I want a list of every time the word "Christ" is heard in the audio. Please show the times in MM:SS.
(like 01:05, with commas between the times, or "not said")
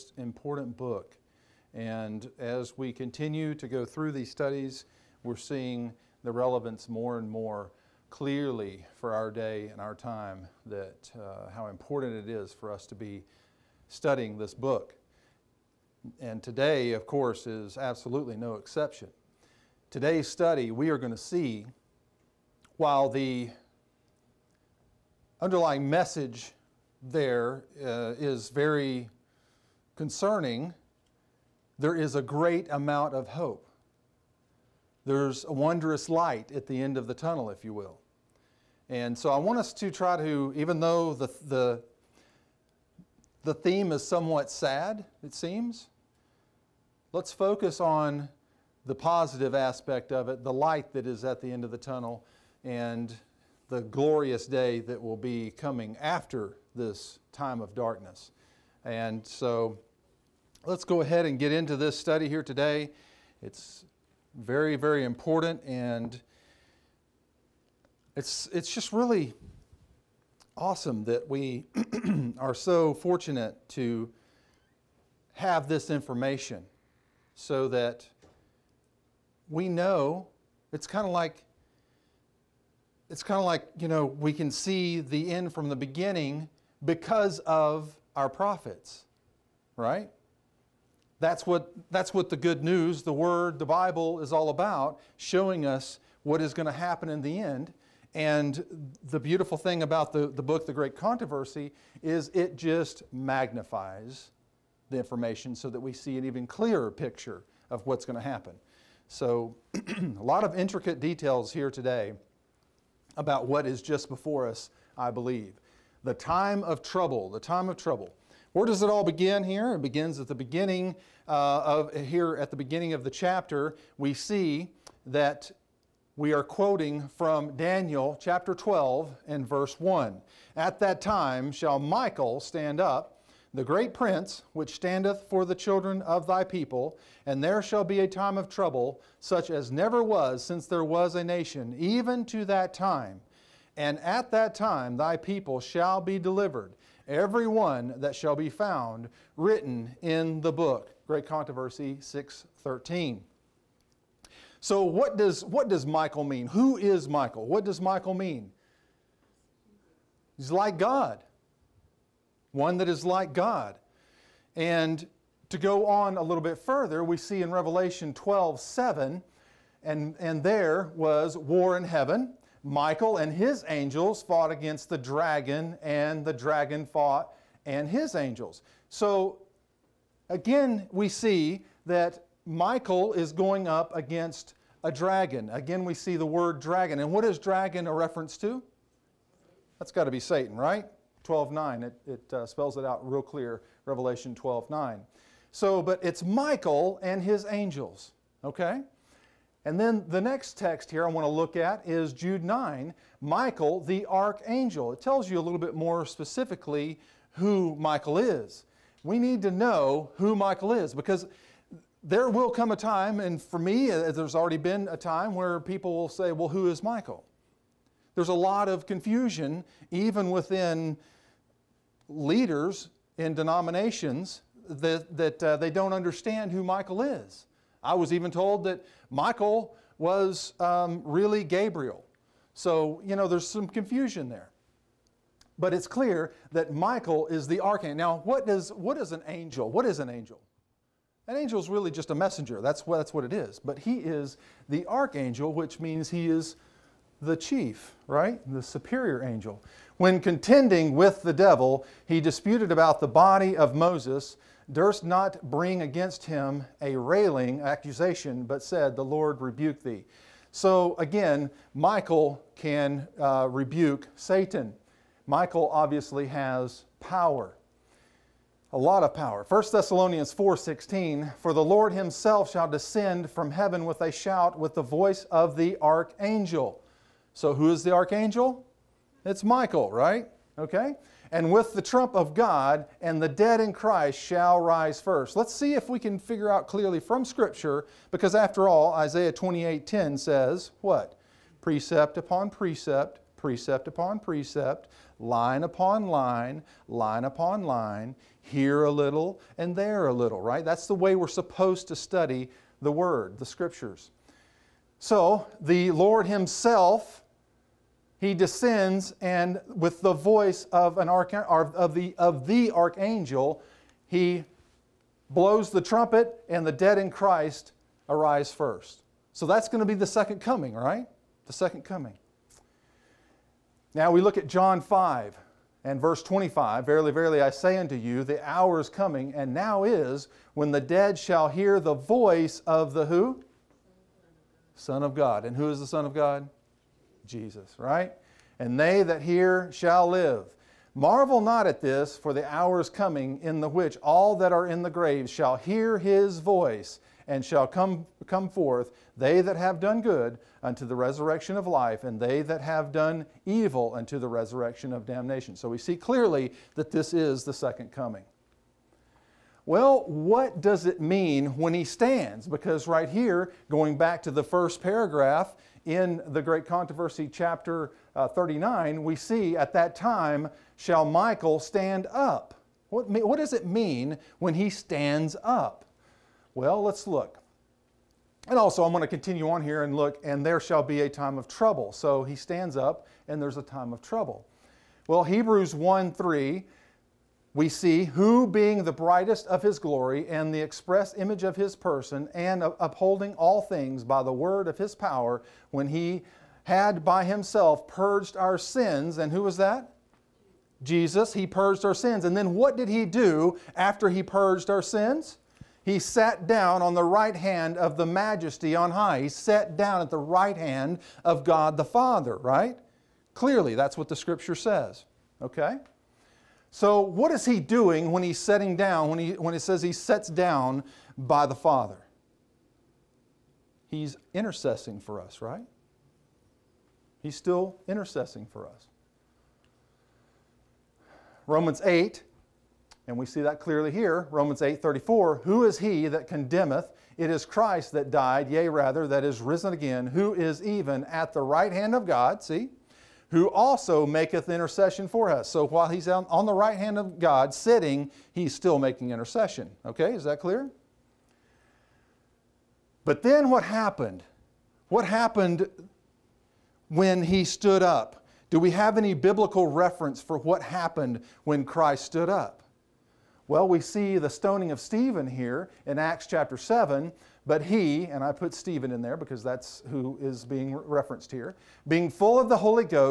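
04:43, 05:17, 07:17, 07:41.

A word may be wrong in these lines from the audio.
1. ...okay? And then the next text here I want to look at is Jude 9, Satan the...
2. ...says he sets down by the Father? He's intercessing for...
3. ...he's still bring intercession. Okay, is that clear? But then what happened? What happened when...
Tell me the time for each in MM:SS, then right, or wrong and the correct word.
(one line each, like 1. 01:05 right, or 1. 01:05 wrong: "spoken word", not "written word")
1. 03:18 wrong: "Michael", not "Satan"
2. 06:59 right
3. 07:28 wrong: "making", not "bring".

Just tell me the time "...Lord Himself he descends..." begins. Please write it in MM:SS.
05:05.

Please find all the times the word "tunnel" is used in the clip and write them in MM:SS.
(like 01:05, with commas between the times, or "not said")
00:37, 00:51.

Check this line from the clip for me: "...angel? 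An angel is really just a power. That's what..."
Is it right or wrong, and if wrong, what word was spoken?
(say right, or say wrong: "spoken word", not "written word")
wrong: "messenger", not "power".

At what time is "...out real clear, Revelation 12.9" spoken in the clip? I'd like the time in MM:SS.
03:12.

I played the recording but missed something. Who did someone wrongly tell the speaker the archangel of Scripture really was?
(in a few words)
Gabriel.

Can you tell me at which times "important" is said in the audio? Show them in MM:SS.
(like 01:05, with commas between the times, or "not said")
00:00, 00:11, 01:05.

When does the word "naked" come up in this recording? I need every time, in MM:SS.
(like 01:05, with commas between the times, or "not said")
not said.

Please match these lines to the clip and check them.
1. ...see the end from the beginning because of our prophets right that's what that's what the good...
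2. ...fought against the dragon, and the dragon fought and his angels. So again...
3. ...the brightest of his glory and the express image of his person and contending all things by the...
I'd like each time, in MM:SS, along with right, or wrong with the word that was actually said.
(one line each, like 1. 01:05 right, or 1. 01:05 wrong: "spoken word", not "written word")
1. 01:24 right
2. 02:54 right
3. 06:28 wrong: "upholding", not "contending".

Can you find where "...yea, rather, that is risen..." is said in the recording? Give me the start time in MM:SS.
07:18.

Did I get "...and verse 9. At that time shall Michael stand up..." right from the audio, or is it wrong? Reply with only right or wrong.
wrong.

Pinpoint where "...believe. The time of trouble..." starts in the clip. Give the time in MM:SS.
01:55.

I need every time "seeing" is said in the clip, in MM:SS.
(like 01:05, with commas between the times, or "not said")
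00:05.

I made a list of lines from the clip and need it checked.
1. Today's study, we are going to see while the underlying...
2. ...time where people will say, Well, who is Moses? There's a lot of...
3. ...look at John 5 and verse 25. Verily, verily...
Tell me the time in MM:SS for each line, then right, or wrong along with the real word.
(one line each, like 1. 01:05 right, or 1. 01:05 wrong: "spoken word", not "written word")
1. 00:19 right
2. 03:34 wrong: "Michael", not "Moses"
3. 05:24 right.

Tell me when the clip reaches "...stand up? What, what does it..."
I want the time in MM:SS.
06:11.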